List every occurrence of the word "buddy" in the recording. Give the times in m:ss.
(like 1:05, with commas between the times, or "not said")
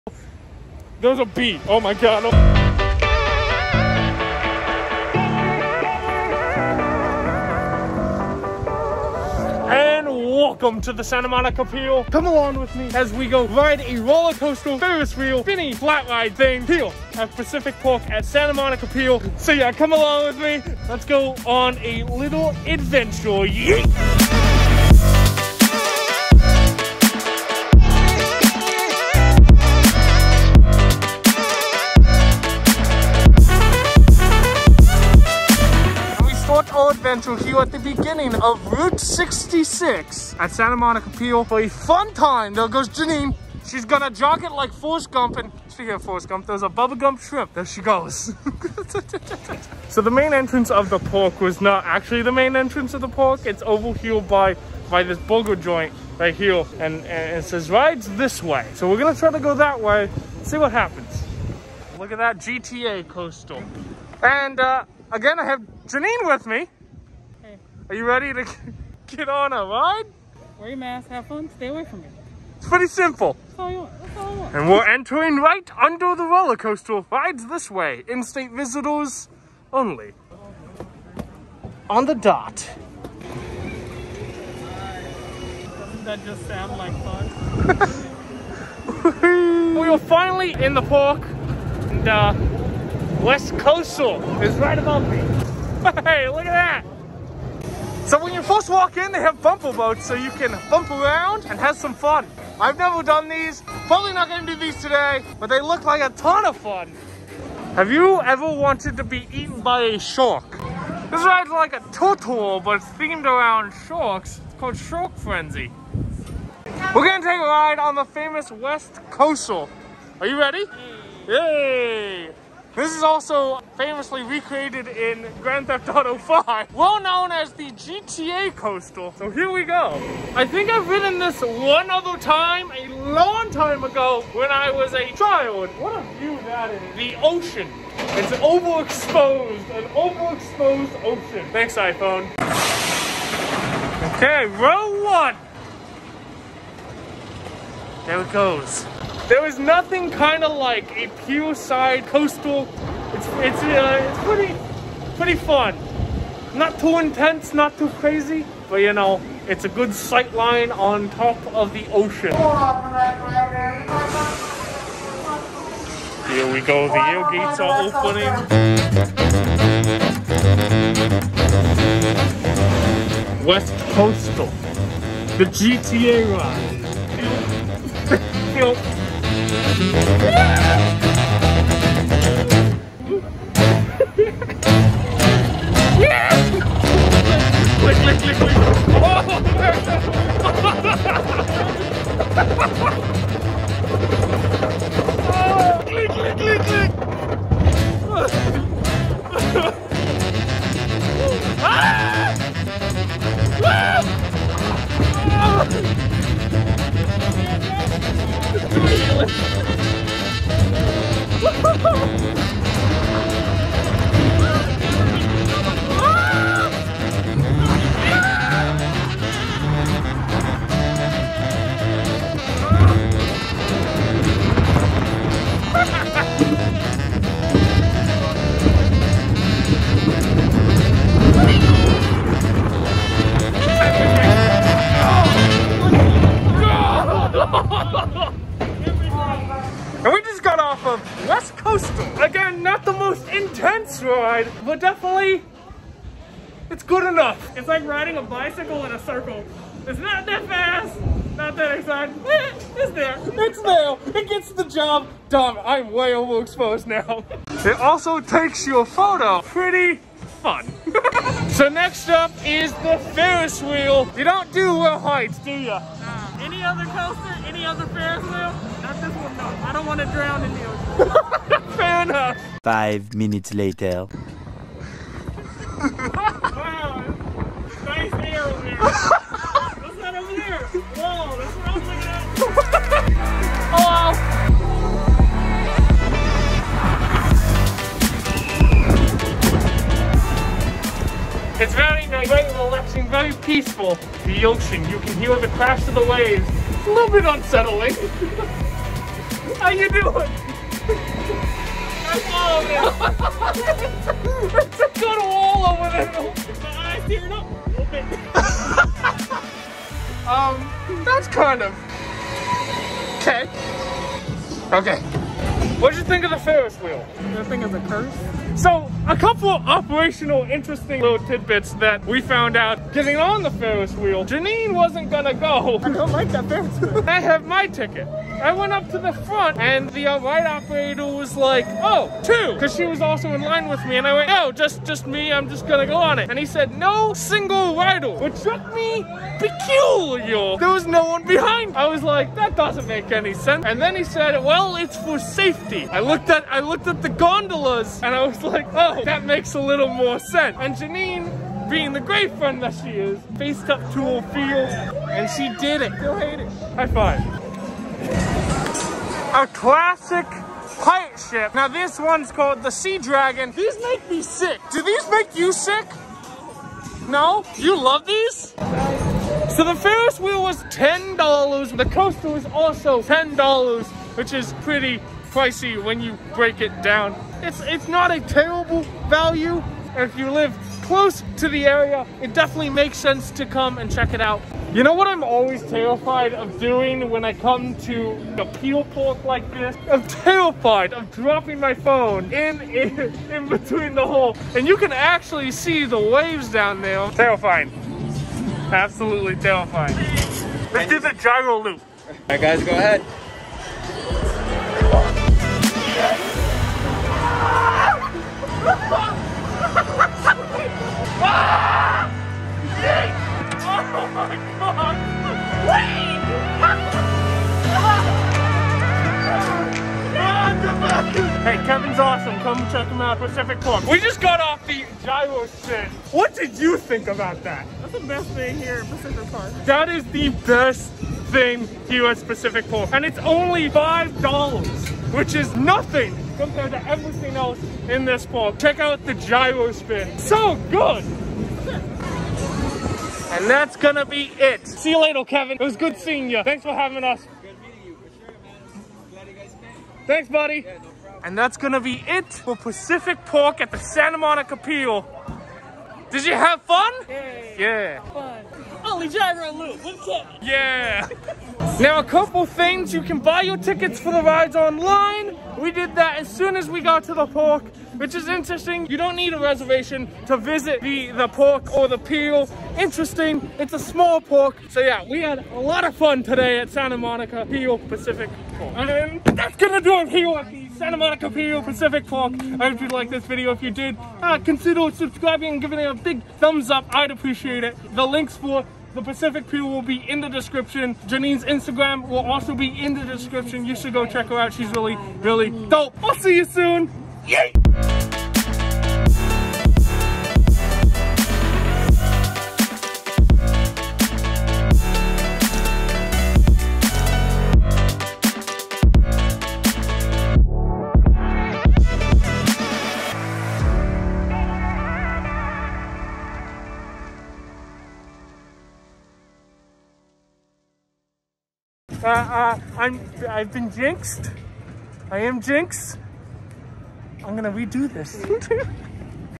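7:30.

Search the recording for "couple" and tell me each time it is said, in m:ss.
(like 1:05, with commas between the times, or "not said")
5:19, 7:42.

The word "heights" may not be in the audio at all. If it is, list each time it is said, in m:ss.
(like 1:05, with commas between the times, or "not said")
4:24.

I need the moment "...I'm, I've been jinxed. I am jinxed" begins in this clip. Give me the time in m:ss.
8:42.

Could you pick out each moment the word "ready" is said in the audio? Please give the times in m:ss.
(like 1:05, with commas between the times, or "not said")
1:08, 2:00.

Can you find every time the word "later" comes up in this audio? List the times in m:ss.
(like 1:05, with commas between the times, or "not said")
4:33, 7:25.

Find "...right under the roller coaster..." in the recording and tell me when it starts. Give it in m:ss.
1:15.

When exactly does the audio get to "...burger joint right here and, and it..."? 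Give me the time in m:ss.
0:55.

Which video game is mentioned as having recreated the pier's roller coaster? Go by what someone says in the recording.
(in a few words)
Grand Theft Auto 5.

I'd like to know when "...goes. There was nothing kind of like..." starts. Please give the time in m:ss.
2:28.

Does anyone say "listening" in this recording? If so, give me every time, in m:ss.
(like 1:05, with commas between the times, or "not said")
not said.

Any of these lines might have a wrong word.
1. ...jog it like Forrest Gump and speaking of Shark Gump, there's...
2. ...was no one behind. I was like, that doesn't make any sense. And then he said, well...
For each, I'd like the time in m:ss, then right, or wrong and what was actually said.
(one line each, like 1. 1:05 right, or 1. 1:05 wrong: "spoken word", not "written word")
1. 0:44 wrong: "Forrest", not "Shark"
2. 5:40 right.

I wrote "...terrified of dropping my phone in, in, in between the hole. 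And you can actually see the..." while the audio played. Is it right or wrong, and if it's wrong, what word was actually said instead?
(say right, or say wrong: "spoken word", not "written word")
right.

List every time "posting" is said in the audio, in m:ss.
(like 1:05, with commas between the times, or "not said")
not said.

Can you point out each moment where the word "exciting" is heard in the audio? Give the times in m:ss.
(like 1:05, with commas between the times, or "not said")
4:11.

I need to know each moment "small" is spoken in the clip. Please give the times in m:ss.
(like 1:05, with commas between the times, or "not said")
7:53.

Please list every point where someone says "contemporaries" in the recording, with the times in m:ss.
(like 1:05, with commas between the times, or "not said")
not said.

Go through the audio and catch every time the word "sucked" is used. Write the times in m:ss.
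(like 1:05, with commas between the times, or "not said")
not said.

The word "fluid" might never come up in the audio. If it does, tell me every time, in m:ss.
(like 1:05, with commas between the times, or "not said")
not said.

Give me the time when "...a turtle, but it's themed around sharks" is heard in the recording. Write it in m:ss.
1:51.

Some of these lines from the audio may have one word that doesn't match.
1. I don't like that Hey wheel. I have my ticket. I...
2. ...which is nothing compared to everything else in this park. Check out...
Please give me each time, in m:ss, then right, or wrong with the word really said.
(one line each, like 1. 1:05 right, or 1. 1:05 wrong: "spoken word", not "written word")
1. 5:25 wrong: "Ferris", not "Hey"
2. 7:15 right.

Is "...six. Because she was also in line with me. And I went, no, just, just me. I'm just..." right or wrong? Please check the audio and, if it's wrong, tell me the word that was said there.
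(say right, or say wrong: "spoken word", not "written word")
wrong: "two", not "six".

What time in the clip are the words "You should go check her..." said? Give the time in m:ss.
8:13.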